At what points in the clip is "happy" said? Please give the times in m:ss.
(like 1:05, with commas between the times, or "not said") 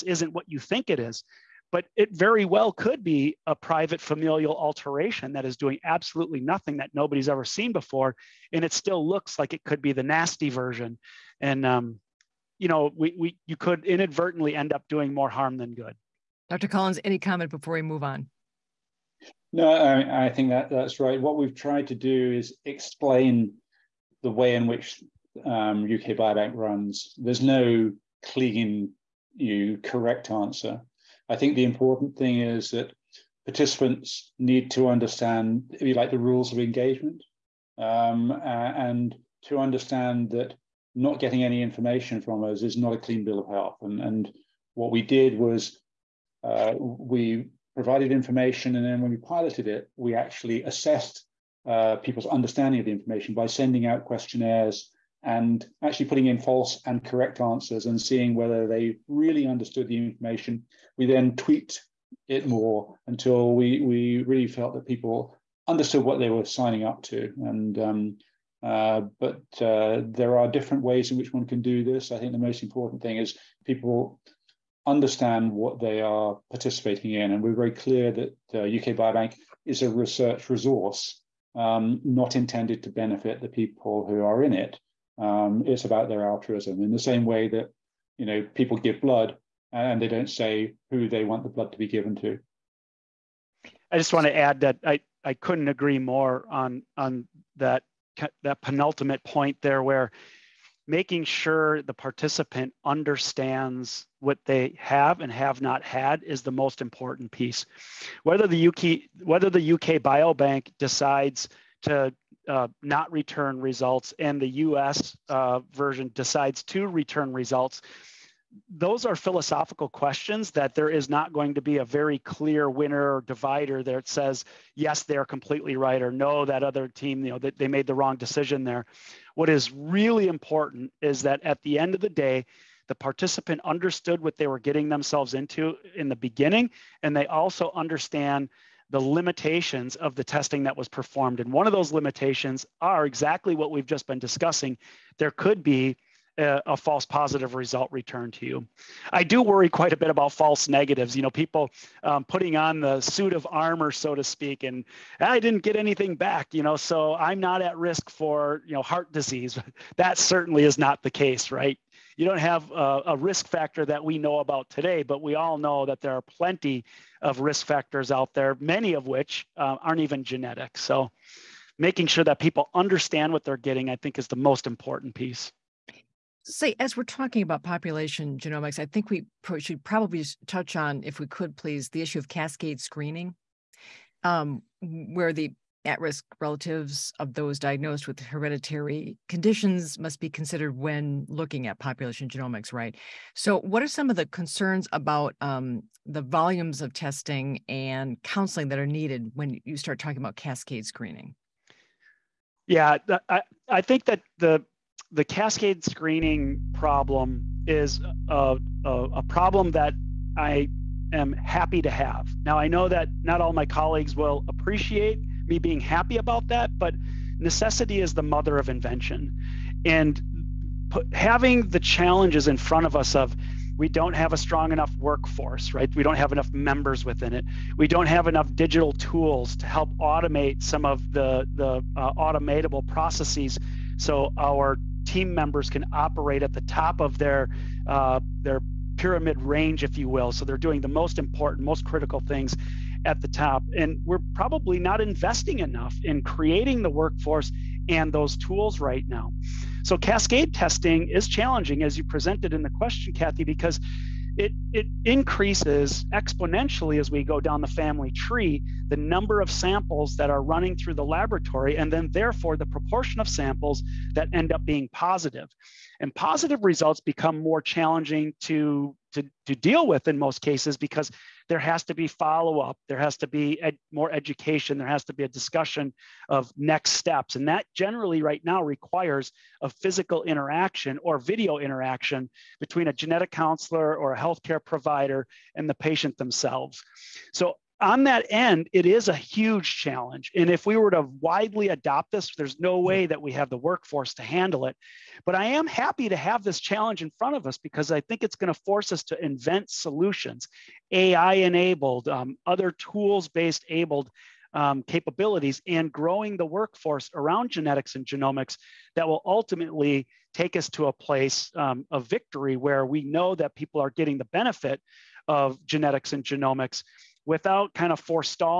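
3:31, 3:35, 4:55.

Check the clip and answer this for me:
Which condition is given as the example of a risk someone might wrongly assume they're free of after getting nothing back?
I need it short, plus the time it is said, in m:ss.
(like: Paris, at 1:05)
heart disease, at 2:38.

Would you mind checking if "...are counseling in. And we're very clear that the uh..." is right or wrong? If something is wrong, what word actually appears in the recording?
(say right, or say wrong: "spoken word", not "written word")
wrong: "participating", not "counseling".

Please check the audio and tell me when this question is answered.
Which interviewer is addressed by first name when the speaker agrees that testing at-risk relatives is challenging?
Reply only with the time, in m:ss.
4:13.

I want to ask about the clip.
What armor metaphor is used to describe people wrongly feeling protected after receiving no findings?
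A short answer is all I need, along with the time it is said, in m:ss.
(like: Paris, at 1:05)
suit of armor, at 2:32.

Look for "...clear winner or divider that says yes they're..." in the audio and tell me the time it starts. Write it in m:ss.
2:02.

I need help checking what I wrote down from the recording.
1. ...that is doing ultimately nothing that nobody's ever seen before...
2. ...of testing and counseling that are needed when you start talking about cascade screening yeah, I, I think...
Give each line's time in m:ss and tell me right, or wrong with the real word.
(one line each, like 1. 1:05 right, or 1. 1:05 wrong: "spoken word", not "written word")
1. 0:05 wrong: "absolutely", not "ultimately"
2. 3:16 right.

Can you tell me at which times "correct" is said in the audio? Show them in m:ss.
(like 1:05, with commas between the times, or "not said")
0:29, 0:57.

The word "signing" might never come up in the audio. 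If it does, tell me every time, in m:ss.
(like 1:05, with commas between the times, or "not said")
1:06.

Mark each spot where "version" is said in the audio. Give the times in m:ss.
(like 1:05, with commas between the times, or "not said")
0:10, 1:55.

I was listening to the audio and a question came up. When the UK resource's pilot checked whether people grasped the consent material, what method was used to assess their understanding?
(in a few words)
questionnaires.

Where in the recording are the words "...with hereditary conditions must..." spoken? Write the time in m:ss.
3:08.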